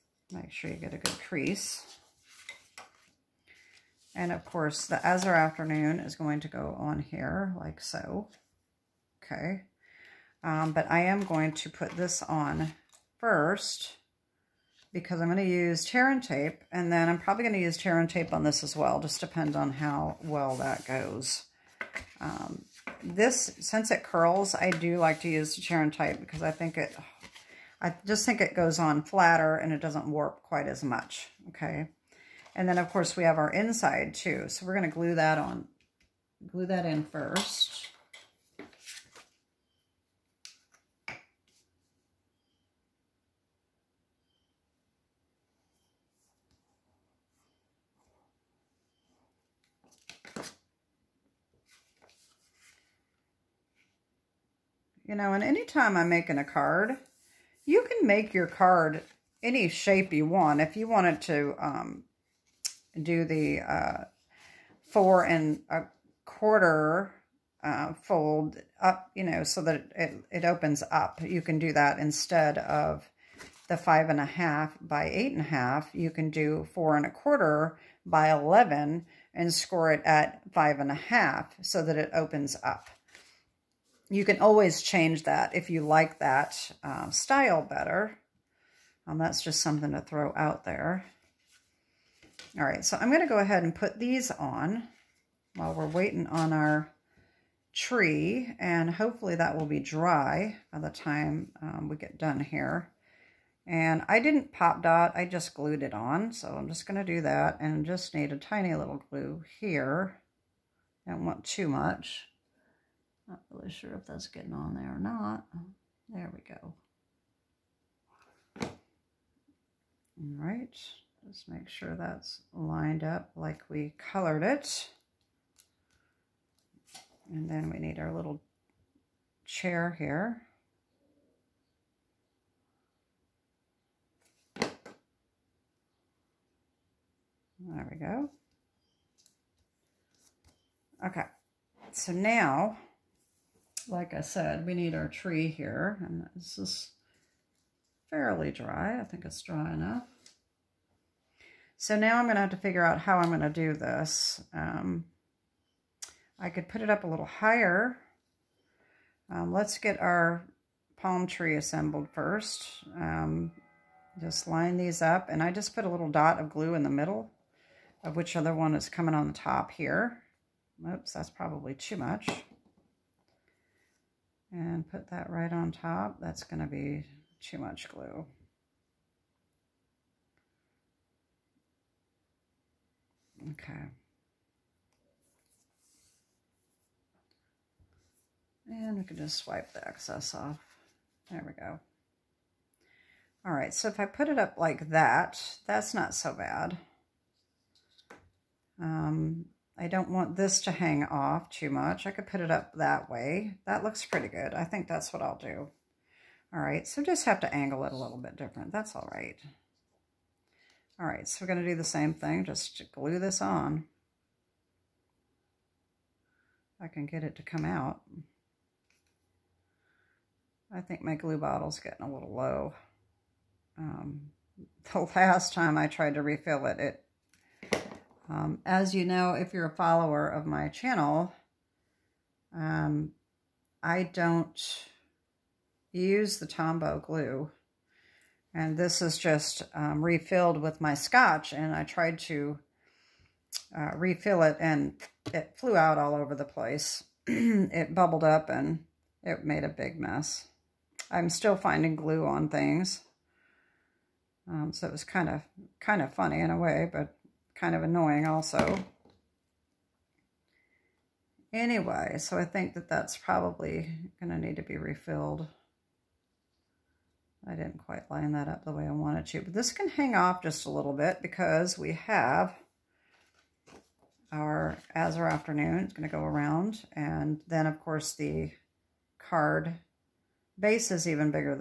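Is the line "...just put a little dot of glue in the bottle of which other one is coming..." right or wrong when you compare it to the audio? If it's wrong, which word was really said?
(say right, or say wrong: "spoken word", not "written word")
wrong: "middle", not "bottle".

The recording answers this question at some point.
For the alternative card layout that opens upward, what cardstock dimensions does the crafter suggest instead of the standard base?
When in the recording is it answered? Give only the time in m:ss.
1:16.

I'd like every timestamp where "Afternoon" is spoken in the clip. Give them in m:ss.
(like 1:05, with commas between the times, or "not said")
0:05, 4:35.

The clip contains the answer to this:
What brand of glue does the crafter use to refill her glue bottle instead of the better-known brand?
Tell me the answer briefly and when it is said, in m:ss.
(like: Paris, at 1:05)
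Scotch, at 4:00.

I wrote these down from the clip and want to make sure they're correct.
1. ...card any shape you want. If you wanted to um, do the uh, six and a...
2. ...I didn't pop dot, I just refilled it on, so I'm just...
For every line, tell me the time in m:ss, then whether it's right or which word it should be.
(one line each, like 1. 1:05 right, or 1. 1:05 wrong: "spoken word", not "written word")
1. 0:58 wrong: "four", not "six"
2. 1:44 wrong: "glued", not "refilled".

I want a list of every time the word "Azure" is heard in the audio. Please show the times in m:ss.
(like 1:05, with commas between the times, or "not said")
0:05, 4:34.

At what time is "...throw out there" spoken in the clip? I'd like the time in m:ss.
1:29.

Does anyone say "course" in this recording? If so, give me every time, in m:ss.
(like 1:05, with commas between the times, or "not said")
0:04, 0:32, 4:37.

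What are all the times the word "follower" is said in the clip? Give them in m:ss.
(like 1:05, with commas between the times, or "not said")
3:49.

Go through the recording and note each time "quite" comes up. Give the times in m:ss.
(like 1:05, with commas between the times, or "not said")
0:30, 4:27.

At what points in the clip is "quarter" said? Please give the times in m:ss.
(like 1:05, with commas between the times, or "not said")
1:06, 1:17.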